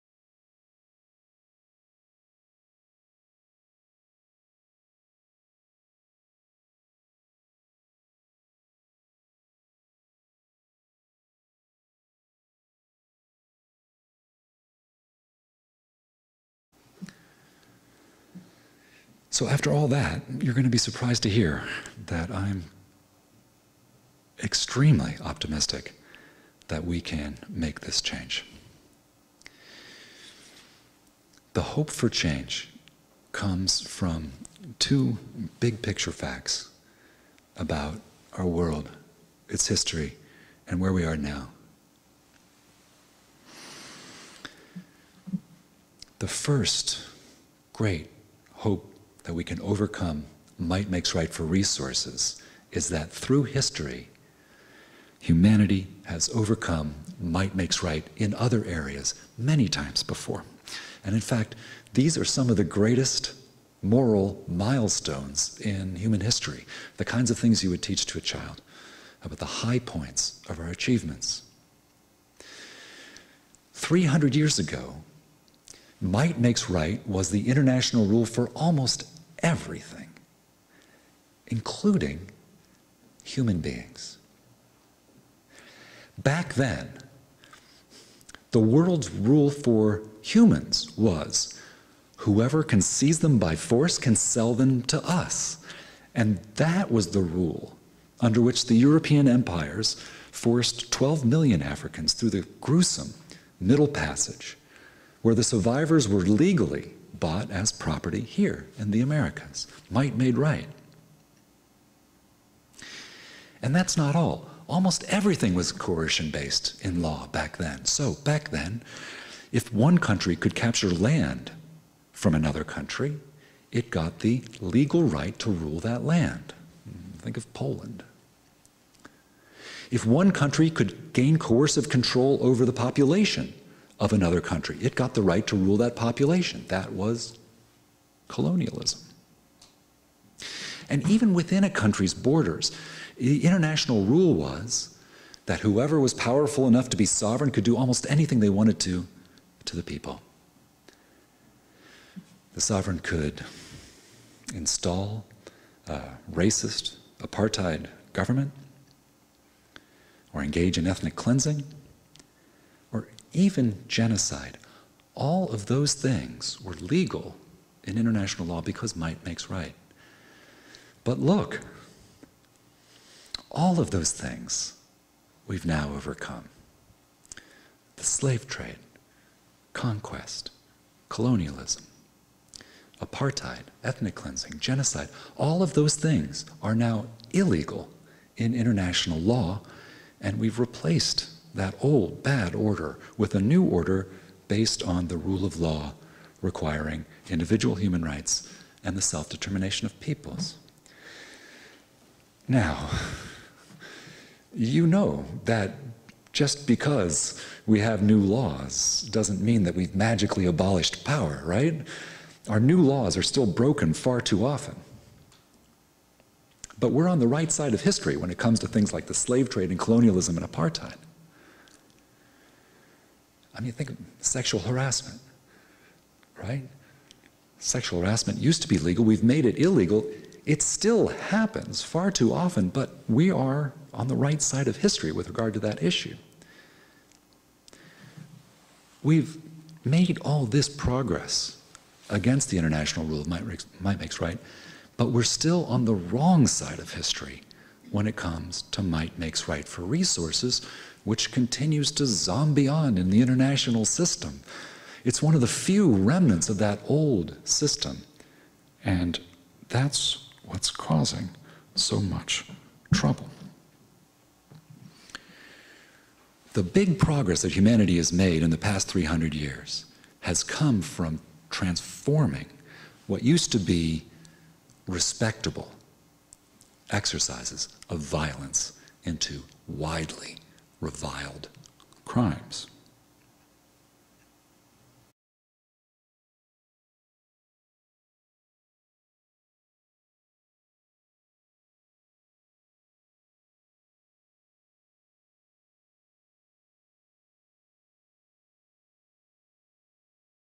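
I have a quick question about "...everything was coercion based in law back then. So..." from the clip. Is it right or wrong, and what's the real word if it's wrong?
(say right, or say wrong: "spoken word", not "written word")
right.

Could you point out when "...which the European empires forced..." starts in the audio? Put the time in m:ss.
1:38.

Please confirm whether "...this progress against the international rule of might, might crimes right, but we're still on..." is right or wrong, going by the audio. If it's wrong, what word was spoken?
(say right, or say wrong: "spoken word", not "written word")
wrong: "makes", not "crimes".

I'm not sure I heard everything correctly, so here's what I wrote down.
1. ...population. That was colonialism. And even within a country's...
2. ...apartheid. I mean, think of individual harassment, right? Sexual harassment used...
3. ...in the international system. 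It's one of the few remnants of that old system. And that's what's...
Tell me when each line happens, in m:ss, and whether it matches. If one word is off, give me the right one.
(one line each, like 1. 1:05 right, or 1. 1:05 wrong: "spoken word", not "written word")
1. 2:15 right
2. 3:40 wrong: "sexual", not "individual"
3. 4:12 right.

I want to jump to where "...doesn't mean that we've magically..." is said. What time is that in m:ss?
3:29.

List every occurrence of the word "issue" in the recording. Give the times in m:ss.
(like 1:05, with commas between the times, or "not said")
3:55.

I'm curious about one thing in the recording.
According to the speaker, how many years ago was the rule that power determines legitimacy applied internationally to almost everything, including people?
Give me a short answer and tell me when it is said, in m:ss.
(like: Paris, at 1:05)
300 years ago, at 1:13.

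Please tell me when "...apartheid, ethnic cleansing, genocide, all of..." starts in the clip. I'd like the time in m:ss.
3:02.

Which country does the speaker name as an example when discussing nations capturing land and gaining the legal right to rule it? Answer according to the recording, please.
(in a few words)
Poland.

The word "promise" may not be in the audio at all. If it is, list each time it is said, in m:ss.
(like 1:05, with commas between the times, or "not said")
not said.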